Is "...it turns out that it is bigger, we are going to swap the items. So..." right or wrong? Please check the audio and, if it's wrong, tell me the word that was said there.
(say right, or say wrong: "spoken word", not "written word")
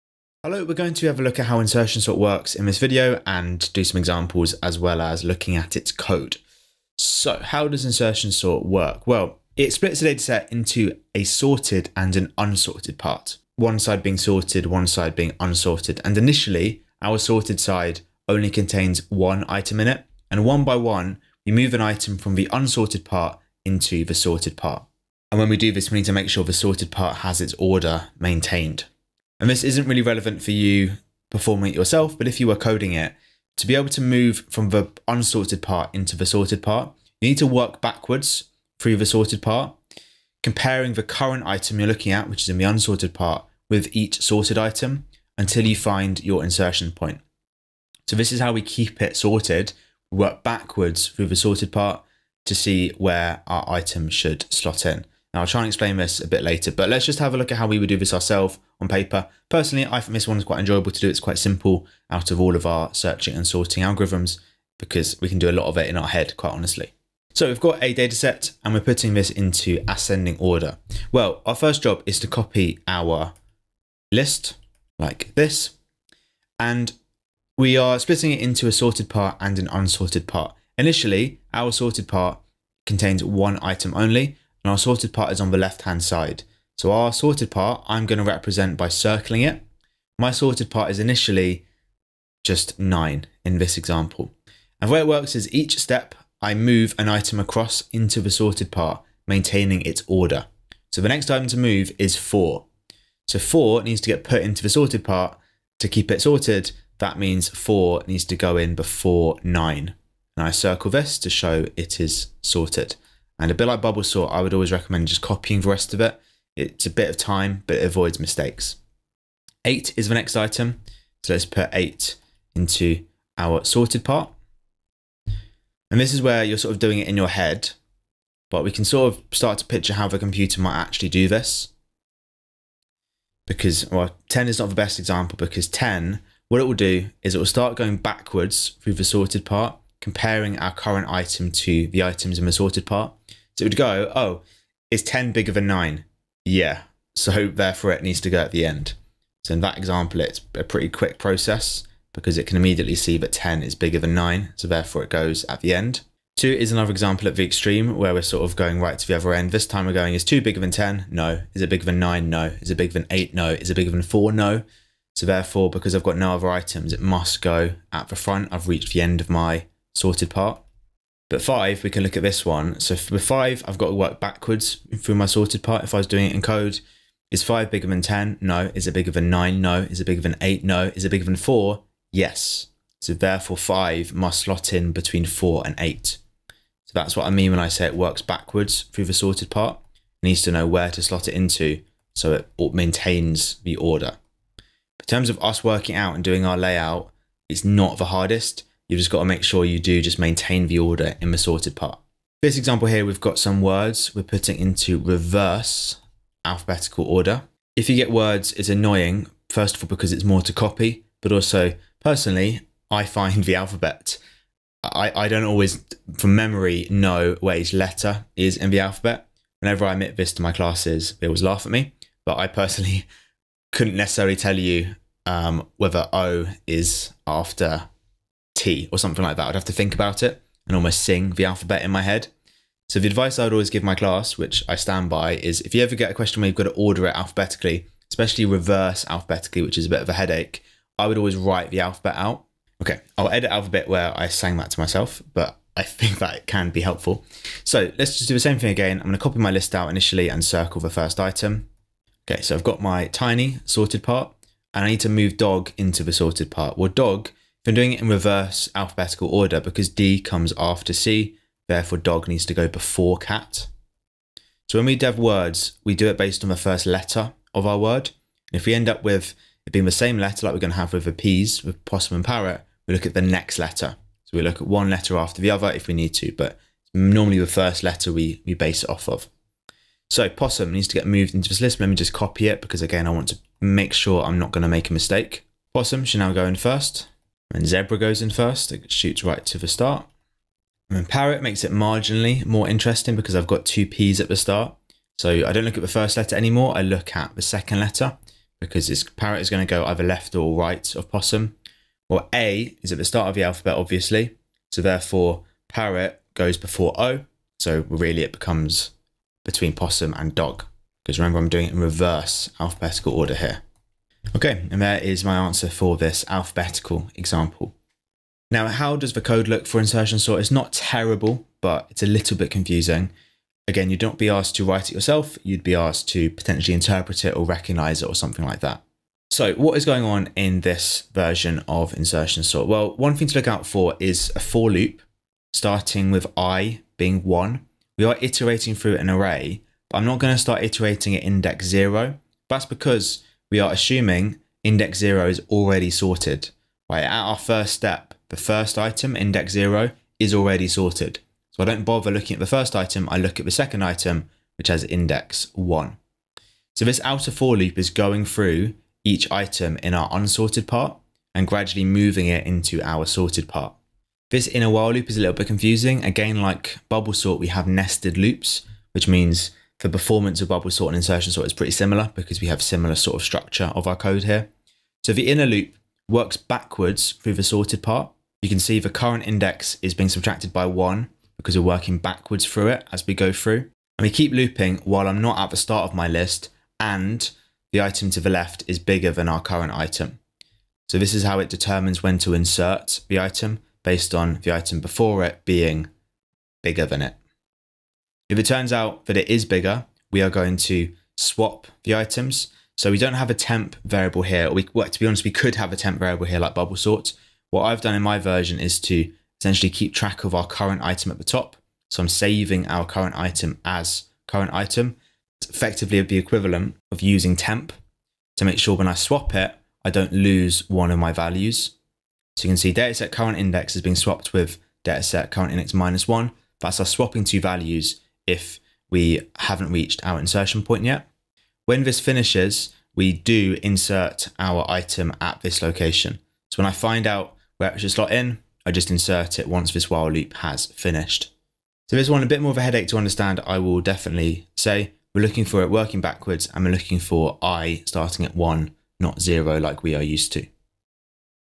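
right.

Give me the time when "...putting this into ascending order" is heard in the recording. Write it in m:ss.
1:08.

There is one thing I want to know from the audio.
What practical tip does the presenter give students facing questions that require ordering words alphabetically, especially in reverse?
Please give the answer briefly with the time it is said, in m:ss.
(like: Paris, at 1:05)
Write the alphabet out, at 4:01.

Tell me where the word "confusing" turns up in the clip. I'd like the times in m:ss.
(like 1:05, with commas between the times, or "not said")
5:22, 6:05.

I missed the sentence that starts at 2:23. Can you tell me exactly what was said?
So it would go, oh, is 10 bigger than 9?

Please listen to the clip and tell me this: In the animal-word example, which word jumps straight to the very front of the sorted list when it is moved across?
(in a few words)
Zebra.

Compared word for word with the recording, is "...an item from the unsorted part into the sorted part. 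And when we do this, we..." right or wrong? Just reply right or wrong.
right.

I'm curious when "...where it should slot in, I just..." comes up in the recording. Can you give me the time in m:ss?
7:17.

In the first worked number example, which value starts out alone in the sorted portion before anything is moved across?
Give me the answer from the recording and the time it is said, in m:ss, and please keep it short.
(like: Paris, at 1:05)
9, at 1:32.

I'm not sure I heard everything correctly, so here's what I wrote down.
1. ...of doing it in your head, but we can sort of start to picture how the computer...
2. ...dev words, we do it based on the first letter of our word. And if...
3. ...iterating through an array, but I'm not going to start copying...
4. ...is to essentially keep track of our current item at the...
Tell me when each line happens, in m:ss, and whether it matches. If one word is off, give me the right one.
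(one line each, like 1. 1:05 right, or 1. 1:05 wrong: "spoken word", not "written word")
1. 2:06 right
2. 4:24 right
3. 5:38 wrong: "iterating", not "copying"
4. 6:48 right.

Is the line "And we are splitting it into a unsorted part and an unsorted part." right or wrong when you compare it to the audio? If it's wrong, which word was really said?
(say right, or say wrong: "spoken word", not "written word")
wrong: "sorted", not "unsorted".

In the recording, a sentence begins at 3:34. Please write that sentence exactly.
I, I don't always, from memory, know where each letter is in the alphabet.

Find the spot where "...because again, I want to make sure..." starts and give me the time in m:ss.
4:42.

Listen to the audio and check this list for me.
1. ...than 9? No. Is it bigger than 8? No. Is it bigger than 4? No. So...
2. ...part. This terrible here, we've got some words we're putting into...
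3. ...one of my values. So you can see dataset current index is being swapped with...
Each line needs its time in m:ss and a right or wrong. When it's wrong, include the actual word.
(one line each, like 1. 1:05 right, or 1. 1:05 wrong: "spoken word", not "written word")
1. 2:41 right
2. 3:21 wrong: "example", not "terrible"
3. 7:00 right.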